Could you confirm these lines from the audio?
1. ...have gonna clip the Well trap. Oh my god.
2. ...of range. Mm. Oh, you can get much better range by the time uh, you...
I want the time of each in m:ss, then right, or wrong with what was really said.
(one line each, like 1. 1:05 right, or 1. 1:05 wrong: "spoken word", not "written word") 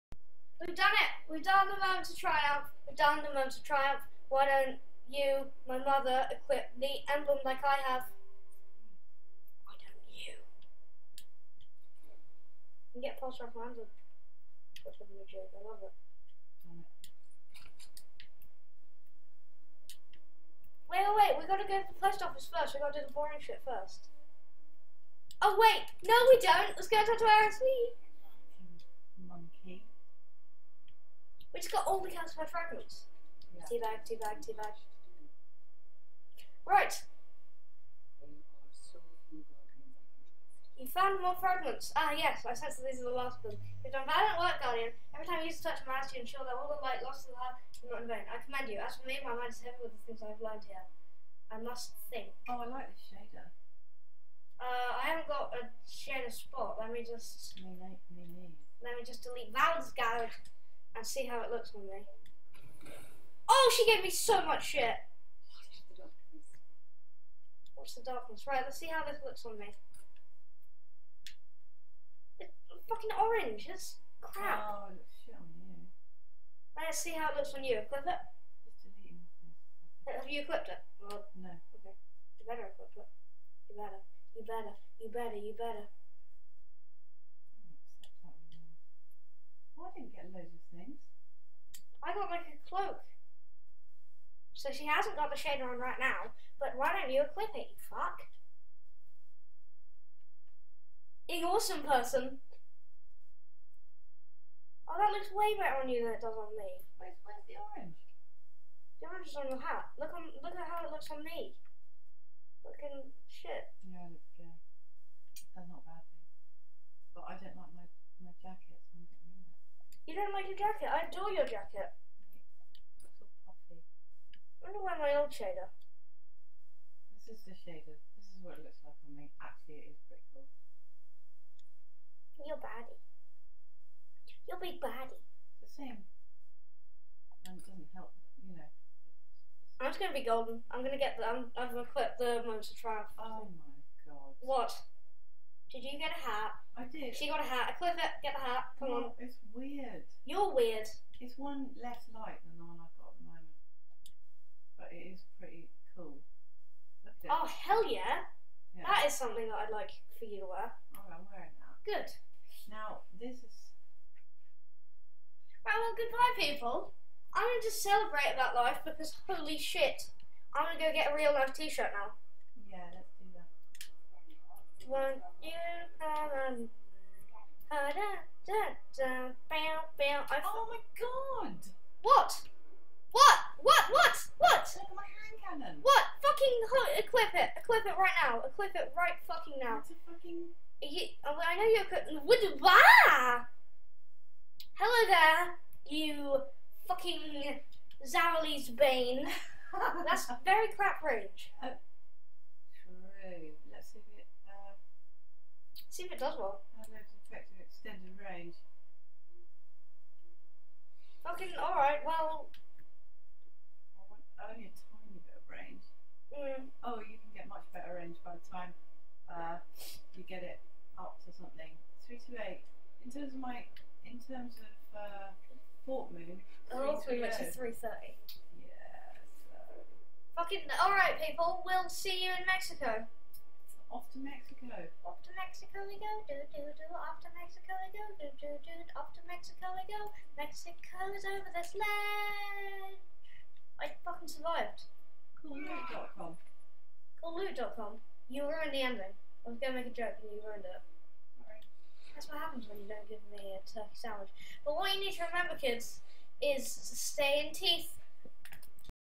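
1. 2:21 wrong: "Monster", not "Well"
2. 3:35 right.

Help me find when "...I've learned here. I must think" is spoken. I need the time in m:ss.
0:50.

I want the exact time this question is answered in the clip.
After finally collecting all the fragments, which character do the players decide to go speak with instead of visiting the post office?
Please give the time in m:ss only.
0:27.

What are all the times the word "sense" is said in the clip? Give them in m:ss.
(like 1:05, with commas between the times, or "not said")
0:42.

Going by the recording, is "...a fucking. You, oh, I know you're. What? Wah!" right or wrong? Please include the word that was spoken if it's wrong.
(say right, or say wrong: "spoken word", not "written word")
right.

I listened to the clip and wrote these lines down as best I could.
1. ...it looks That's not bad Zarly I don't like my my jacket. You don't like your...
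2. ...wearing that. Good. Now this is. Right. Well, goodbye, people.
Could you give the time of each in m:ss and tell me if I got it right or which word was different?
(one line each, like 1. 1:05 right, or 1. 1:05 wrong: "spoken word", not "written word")
1. 1:54 wrong: "But", not "Zarly"
2. 2:41 right.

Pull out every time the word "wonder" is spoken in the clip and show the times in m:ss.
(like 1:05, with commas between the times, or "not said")
2:04.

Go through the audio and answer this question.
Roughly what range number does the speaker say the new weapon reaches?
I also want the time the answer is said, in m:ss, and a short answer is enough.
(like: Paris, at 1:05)
330, at 3:47.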